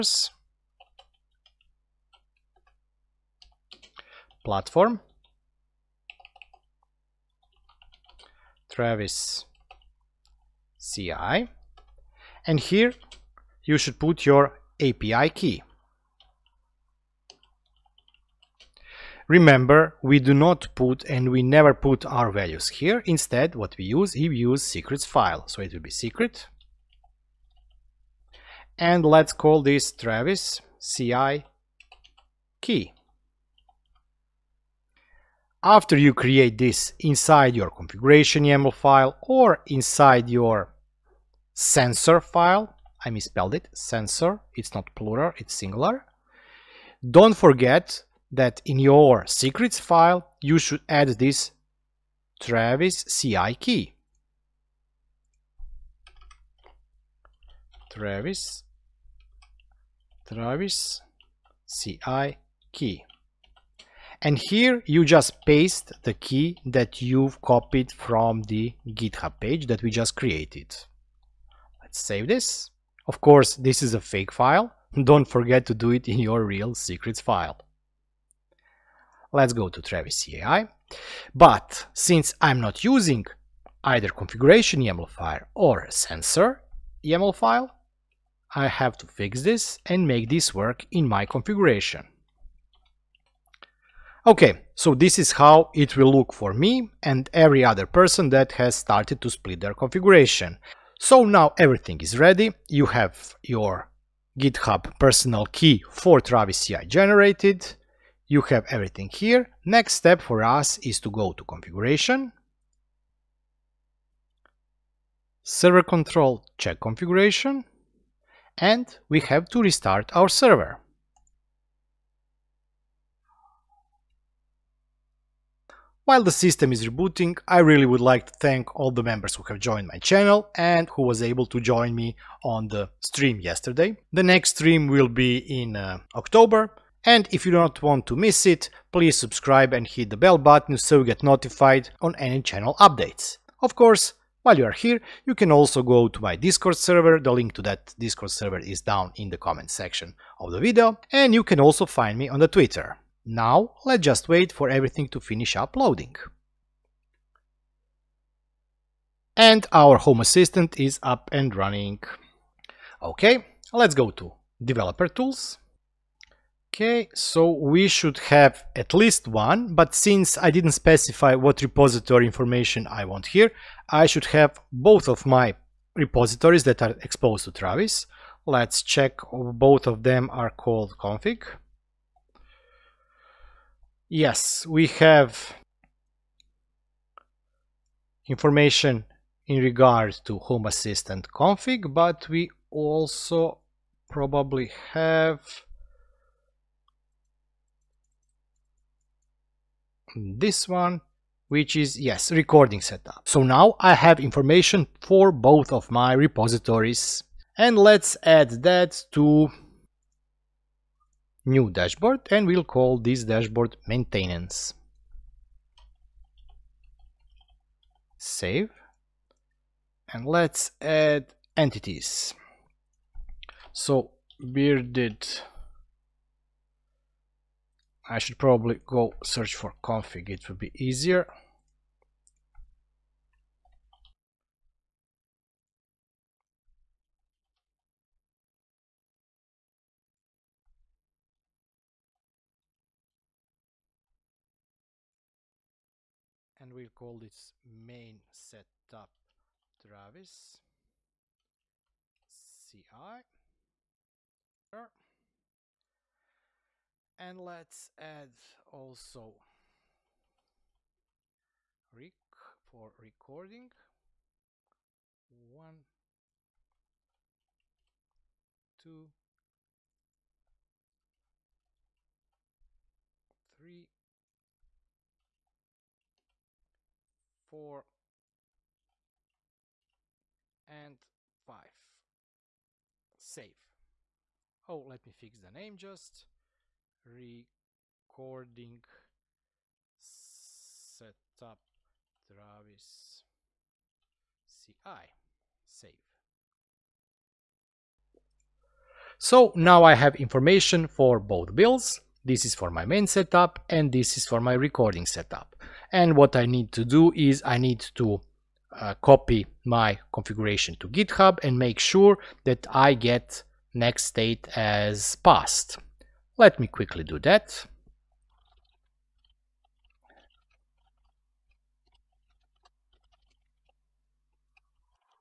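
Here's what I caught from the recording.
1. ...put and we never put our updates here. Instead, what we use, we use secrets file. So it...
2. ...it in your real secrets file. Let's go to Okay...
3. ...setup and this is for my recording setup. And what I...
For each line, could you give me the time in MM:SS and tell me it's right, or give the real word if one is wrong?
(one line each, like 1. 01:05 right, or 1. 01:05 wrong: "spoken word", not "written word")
1. 00:20 wrong: "values", not "updates"
2. 01:15 wrong: "Travis", not "Okay"
3. 05:03 right.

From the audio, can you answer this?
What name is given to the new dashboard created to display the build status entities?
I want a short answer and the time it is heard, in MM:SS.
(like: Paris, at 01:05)
maintenance, at 03:33.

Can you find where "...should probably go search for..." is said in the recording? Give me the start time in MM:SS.
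03:48.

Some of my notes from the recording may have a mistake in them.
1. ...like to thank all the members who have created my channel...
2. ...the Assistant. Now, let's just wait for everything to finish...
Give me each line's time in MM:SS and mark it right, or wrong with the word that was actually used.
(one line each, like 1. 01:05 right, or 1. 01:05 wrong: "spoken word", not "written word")
1. 02:08 wrong: "joined", not "created"
2. 02:32 wrong: "Twitter", not "Assistant".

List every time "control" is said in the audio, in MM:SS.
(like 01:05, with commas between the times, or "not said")
01:55.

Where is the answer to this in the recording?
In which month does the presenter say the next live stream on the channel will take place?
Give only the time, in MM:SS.
02:16.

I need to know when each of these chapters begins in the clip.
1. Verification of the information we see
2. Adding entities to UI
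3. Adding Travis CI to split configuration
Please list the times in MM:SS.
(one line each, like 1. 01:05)
1. 02:42
2. 03:38
3. 01:21.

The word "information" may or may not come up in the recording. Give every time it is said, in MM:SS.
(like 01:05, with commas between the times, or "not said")
02:52, 03:08, 03:24, 05:00.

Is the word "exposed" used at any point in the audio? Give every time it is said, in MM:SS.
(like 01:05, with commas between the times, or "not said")
02:57.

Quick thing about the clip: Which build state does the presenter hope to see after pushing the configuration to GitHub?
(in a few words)
passed.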